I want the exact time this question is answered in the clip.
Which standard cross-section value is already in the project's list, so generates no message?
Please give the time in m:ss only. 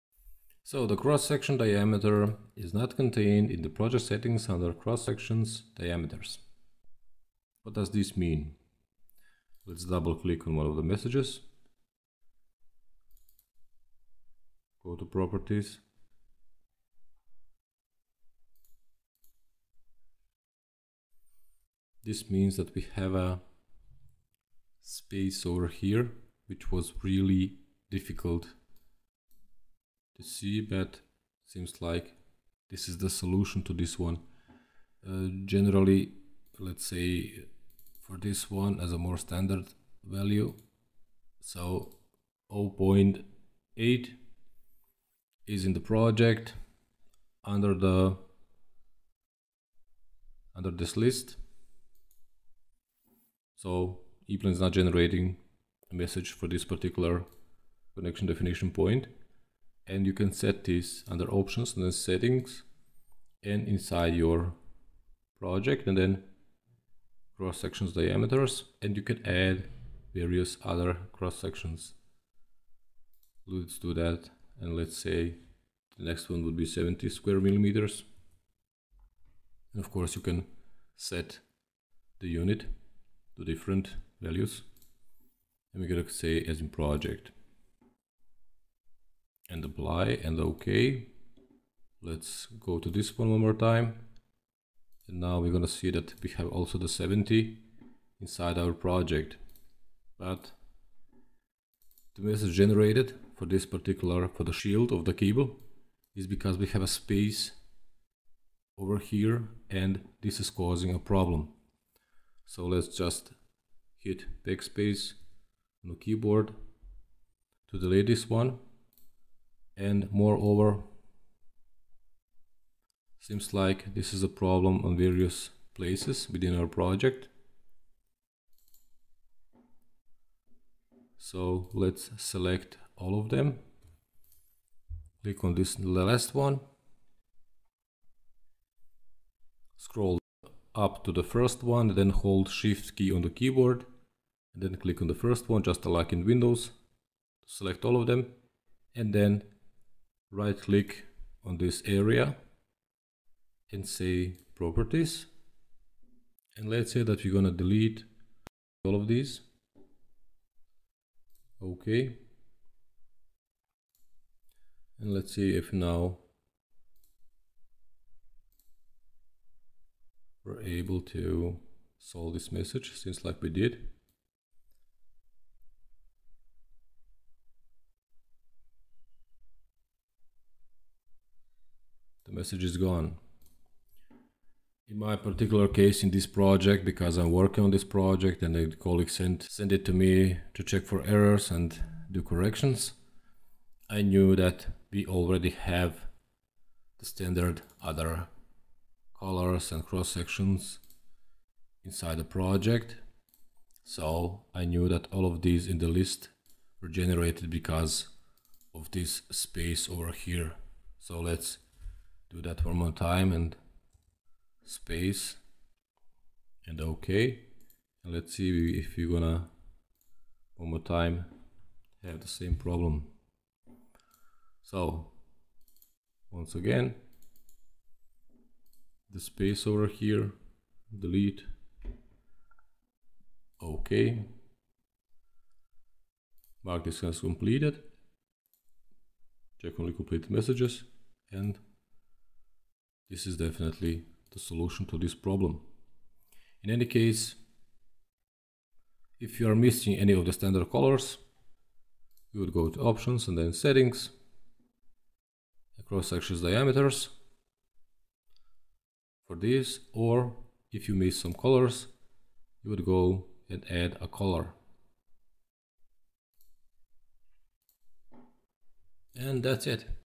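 0:42.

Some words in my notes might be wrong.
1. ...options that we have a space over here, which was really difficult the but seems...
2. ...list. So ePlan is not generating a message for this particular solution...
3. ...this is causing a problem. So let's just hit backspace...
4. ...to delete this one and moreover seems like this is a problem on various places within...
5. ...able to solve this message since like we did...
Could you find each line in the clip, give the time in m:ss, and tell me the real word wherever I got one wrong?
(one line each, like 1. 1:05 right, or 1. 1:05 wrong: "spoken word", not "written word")
1. 0:22 wrong: "means", not "options"
2. 0:50 wrong: "connection", not "solution"
3. 1:50 right
4. 1:57 right
5. 2:50 right.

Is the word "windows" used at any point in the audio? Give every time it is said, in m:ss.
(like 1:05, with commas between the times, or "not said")
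2:26.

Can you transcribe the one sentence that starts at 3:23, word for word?
So I knew that all of these in the list were generated because of this space over here.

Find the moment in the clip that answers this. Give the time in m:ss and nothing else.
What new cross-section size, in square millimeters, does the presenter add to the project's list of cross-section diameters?
1:16.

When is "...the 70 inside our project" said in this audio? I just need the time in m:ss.
1:36.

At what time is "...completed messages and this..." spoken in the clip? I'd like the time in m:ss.
3:59.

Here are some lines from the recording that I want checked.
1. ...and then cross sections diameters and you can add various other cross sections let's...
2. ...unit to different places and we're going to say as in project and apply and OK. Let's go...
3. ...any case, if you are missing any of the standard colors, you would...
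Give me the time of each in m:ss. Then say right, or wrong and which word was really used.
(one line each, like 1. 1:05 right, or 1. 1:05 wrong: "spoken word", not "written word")
1. 1:05 right
2. 1:22 wrong: "values", not "places"
3. 4:06 right.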